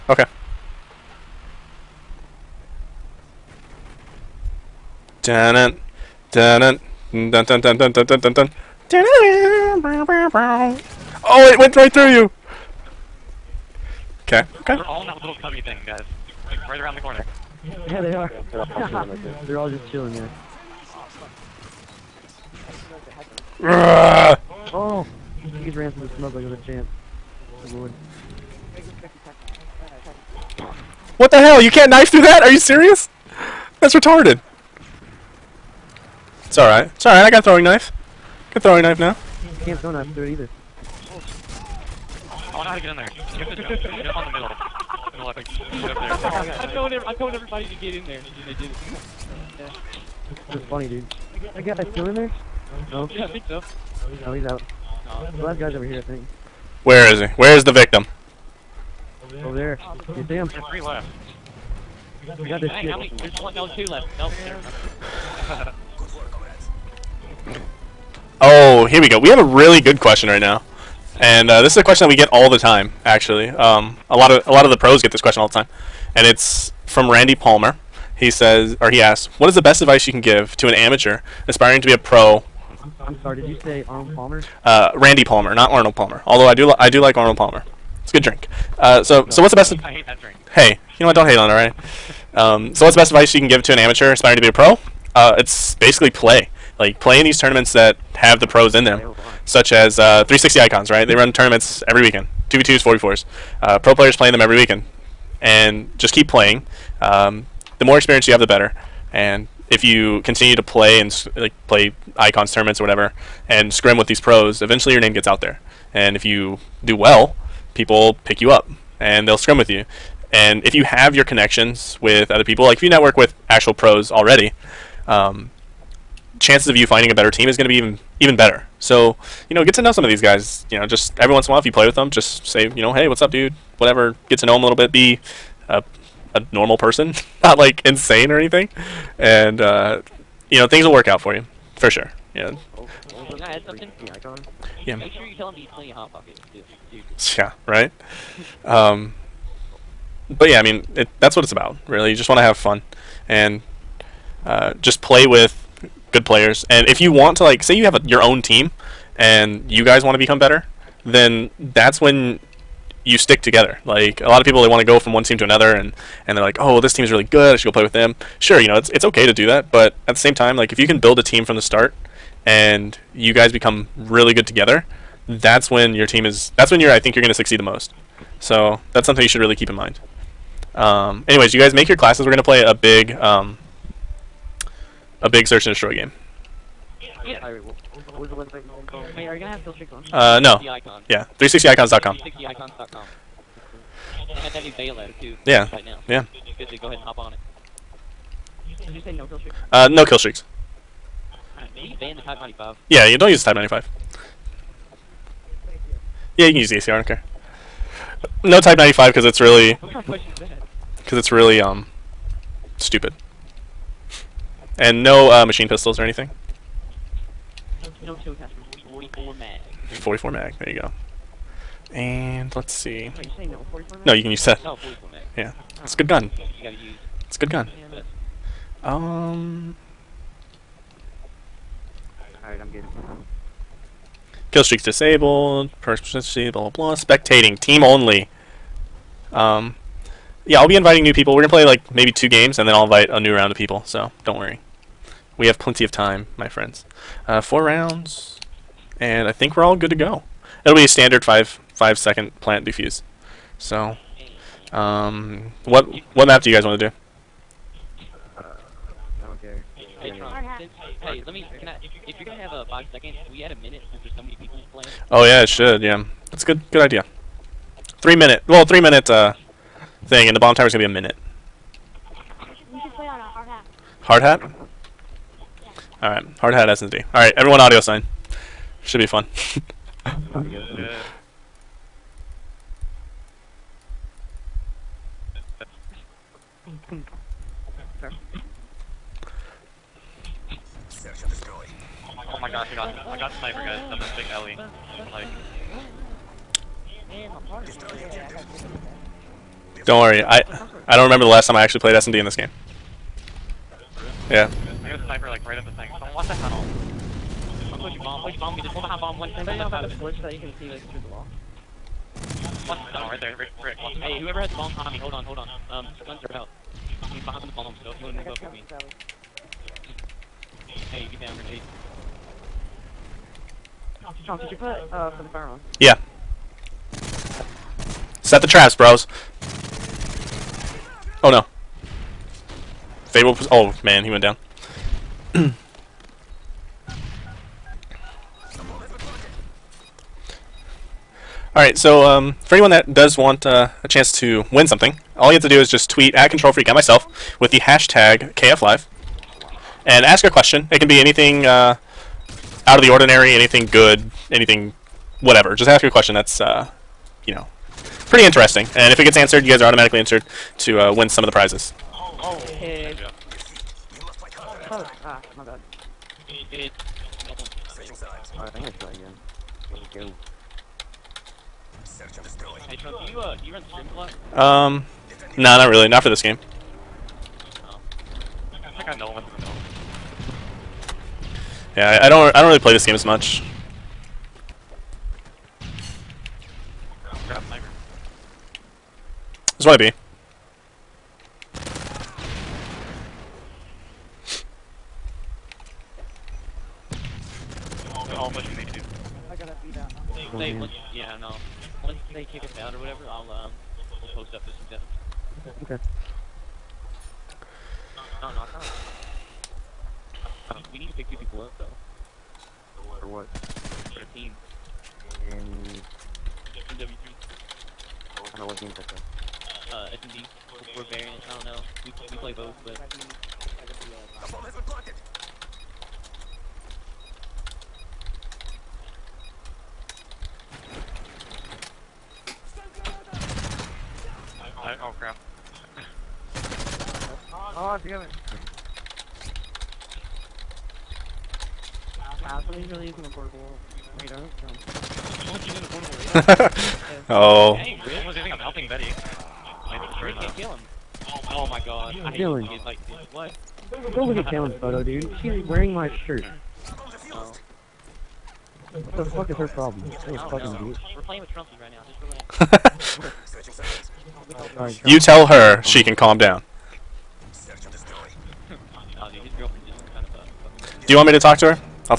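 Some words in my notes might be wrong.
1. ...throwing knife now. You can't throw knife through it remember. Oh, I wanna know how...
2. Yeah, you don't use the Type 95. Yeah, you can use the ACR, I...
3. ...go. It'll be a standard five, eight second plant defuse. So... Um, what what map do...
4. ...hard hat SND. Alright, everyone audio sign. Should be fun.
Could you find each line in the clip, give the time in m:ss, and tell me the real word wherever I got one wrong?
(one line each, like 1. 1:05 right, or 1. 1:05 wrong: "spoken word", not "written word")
1. 0:38 wrong: "either", not "remember"
2. 3:22 right
3. 4:09 wrong: "five", not "eight"
4. 4:36 right.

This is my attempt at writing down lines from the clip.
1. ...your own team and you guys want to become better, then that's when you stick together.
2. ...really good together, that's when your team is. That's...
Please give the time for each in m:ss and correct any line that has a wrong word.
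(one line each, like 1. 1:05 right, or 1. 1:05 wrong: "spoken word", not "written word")
1. 2:38 right
2. 2:53 right.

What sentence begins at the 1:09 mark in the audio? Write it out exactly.
We have a really good question right now.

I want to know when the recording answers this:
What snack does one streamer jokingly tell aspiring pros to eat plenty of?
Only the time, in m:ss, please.
2:25.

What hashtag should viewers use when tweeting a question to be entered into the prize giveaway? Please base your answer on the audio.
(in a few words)
#KFLive.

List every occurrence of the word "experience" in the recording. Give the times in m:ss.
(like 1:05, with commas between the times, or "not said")
1:47.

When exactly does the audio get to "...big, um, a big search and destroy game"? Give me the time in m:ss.
3:02.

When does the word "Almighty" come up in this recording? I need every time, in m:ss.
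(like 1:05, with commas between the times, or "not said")
not said.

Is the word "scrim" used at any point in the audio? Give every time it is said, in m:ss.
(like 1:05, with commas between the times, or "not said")
1:53, 1:59.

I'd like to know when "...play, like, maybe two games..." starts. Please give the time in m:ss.
4:01.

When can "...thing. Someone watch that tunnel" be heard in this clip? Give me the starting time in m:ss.
5:05.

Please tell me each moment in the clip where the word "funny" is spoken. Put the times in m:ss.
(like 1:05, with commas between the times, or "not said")
0:50.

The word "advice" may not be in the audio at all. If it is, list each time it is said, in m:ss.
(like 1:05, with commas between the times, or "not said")
1:19, 1:33.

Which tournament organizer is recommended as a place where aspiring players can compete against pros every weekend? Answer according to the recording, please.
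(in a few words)
360 Icons.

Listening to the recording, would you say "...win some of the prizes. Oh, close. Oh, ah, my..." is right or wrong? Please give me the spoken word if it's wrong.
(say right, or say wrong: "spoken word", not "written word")
right.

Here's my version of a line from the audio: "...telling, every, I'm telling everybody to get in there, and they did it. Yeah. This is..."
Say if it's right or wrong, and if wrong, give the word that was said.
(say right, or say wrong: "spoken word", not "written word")
right.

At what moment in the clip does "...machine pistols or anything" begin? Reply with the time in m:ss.
3:35.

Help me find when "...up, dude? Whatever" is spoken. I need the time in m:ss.
2:13.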